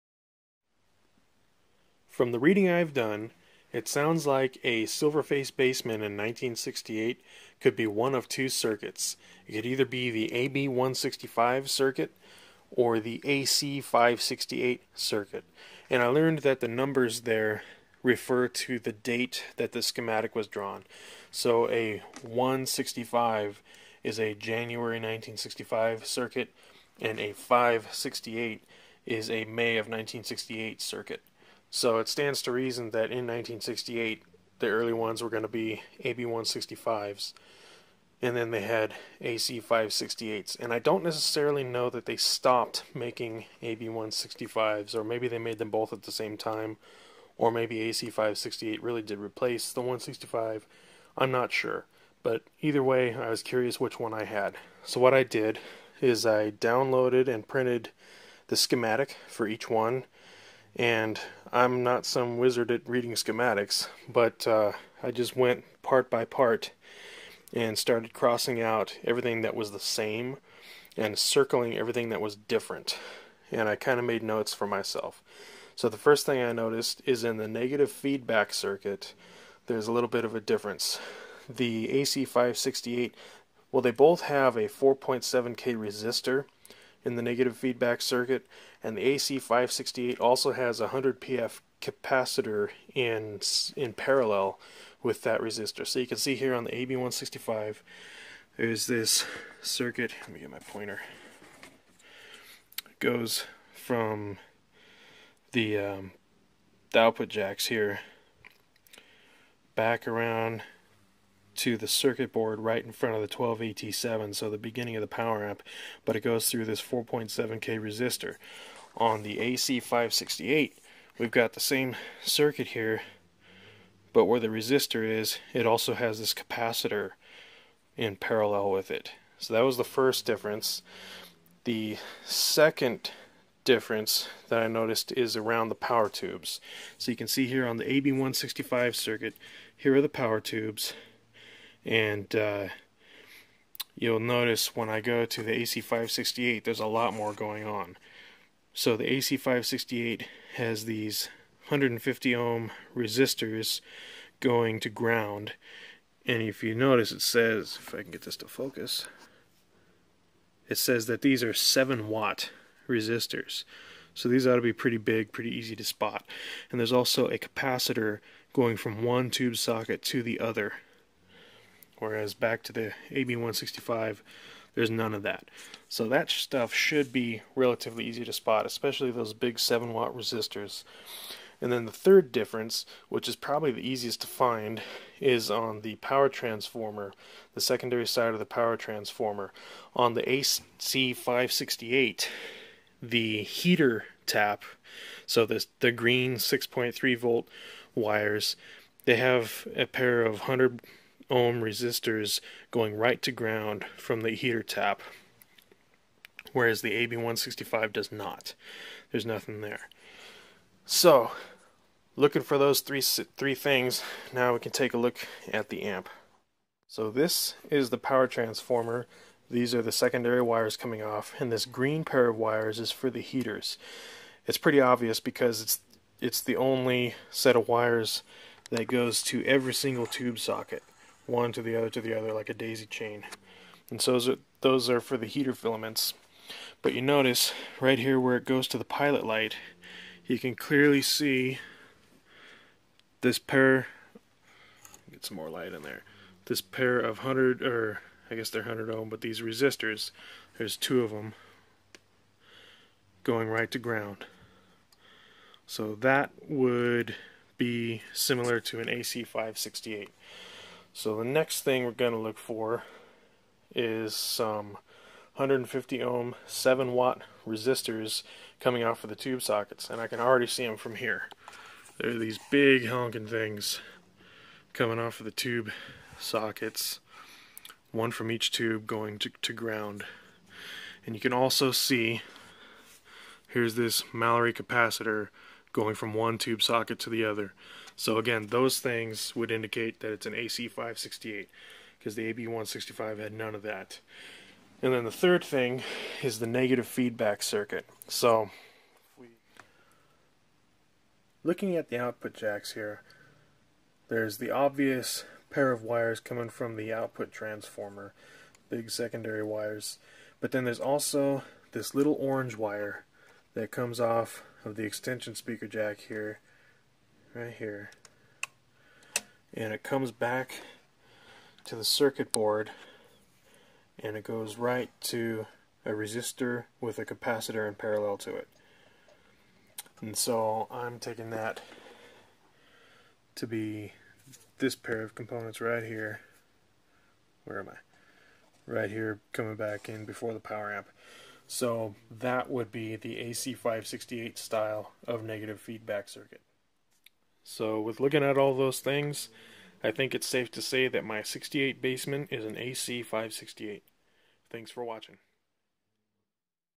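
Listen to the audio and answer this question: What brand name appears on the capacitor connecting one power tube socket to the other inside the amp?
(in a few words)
Mallory.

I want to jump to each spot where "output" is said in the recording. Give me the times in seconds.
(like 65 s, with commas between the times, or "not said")
106 s, 301 s, 306 s.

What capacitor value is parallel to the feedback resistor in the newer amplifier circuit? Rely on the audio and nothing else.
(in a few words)
100 pF.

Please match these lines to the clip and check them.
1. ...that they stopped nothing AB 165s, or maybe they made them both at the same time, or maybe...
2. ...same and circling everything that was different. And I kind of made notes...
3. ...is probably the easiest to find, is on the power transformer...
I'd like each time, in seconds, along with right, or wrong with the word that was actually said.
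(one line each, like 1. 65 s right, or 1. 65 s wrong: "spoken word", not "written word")
1. 41 s wrong: "making", not "nothing"
2. 69 s right
3. 183 s right.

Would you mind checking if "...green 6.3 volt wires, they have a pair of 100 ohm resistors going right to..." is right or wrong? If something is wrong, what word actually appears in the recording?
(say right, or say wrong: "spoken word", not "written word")
right.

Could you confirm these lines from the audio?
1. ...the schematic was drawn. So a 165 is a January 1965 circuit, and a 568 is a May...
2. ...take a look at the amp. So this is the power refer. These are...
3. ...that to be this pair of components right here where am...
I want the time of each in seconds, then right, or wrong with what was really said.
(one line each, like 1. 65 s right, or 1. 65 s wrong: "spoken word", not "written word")
1. 19 s right
2. 214 s wrong: "transformer", not "refer"
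3. 331 s right.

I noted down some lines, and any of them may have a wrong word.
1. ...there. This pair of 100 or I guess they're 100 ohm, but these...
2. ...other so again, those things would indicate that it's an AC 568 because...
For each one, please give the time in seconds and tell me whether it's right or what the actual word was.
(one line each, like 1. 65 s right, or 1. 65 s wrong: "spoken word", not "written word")
1. 245 s right
2. 287 s right.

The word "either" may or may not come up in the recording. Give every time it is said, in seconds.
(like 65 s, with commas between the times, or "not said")
9 s, 52 s.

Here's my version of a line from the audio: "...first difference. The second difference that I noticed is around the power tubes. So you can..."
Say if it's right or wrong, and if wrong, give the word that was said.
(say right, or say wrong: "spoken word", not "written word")
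right.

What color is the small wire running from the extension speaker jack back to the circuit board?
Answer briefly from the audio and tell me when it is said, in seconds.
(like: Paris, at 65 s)
Orange, at 312 s.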